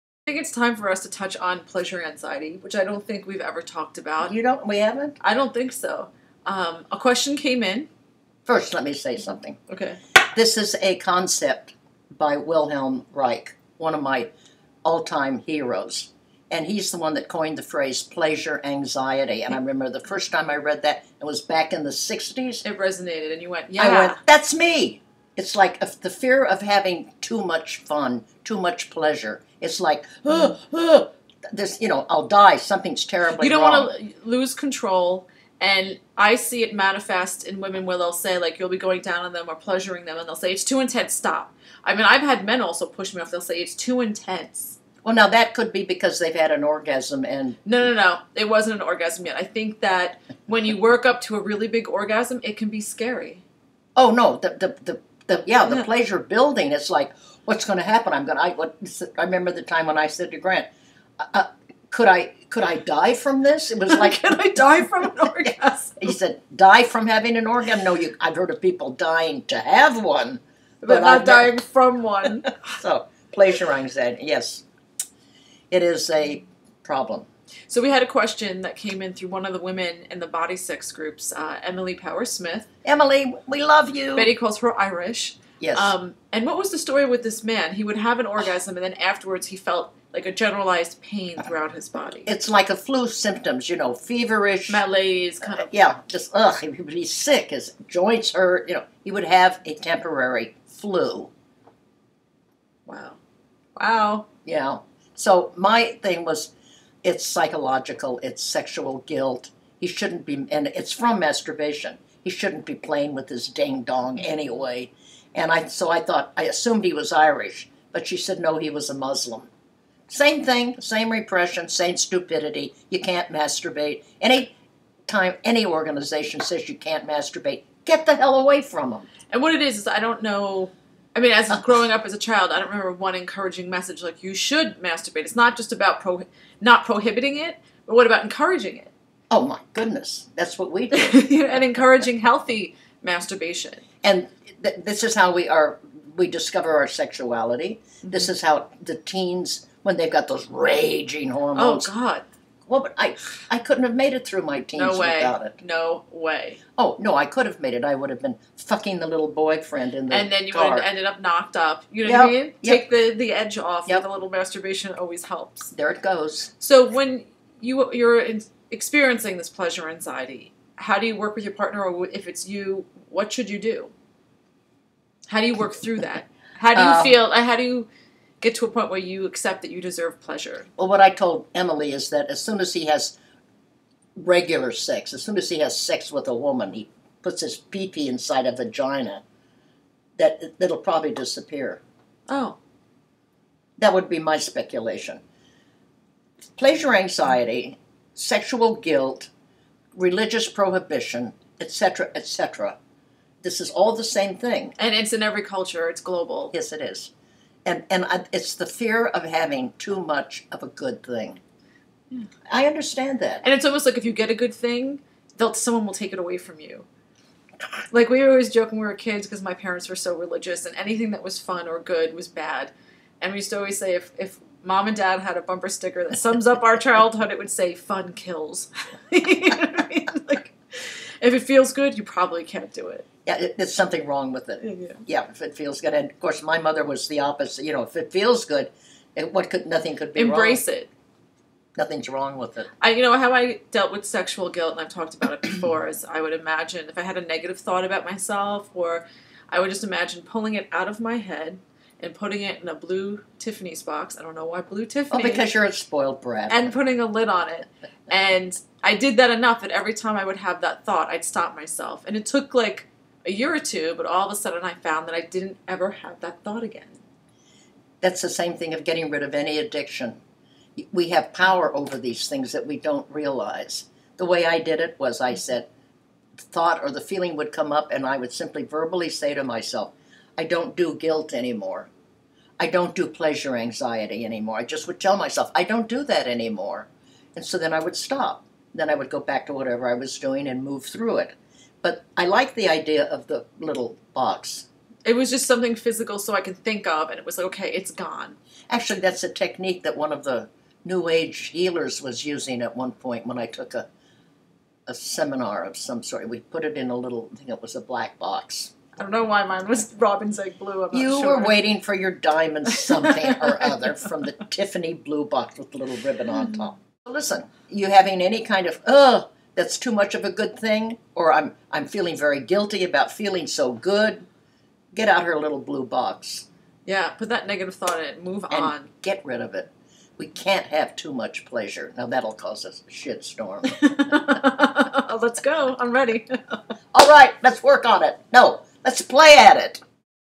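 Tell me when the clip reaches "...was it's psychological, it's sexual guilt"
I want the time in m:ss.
1:46.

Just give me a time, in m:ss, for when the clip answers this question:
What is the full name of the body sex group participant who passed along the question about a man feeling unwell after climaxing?
1:21.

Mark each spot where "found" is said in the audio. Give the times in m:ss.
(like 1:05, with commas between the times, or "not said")
4:24.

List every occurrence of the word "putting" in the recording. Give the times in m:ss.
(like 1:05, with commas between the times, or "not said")
4:12, 4:16.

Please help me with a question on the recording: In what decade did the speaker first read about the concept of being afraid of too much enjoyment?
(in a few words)
the 60s.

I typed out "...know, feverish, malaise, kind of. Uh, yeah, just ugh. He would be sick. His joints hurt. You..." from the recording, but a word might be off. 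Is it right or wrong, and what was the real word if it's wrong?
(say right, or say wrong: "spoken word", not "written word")
right.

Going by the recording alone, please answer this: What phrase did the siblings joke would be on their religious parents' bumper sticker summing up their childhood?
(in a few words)
Fun kills.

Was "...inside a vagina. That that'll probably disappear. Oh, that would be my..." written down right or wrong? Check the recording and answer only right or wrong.
right.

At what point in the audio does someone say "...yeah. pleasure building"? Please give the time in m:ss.
0:55.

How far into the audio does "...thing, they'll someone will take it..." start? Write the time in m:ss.
3:34.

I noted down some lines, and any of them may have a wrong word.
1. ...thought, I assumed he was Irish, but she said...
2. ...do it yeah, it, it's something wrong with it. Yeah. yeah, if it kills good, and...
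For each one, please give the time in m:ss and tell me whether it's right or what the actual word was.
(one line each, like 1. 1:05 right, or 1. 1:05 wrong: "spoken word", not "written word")
1. 1:56 right
2. 3:52 wrong: "feels", not "kills".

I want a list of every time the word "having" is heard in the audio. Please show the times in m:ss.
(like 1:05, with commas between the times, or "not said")
0:26, 1:07, 3:29, 5:17.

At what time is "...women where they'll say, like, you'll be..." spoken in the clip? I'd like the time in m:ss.
0:37.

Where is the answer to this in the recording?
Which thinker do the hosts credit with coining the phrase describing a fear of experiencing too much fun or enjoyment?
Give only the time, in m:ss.
0:12.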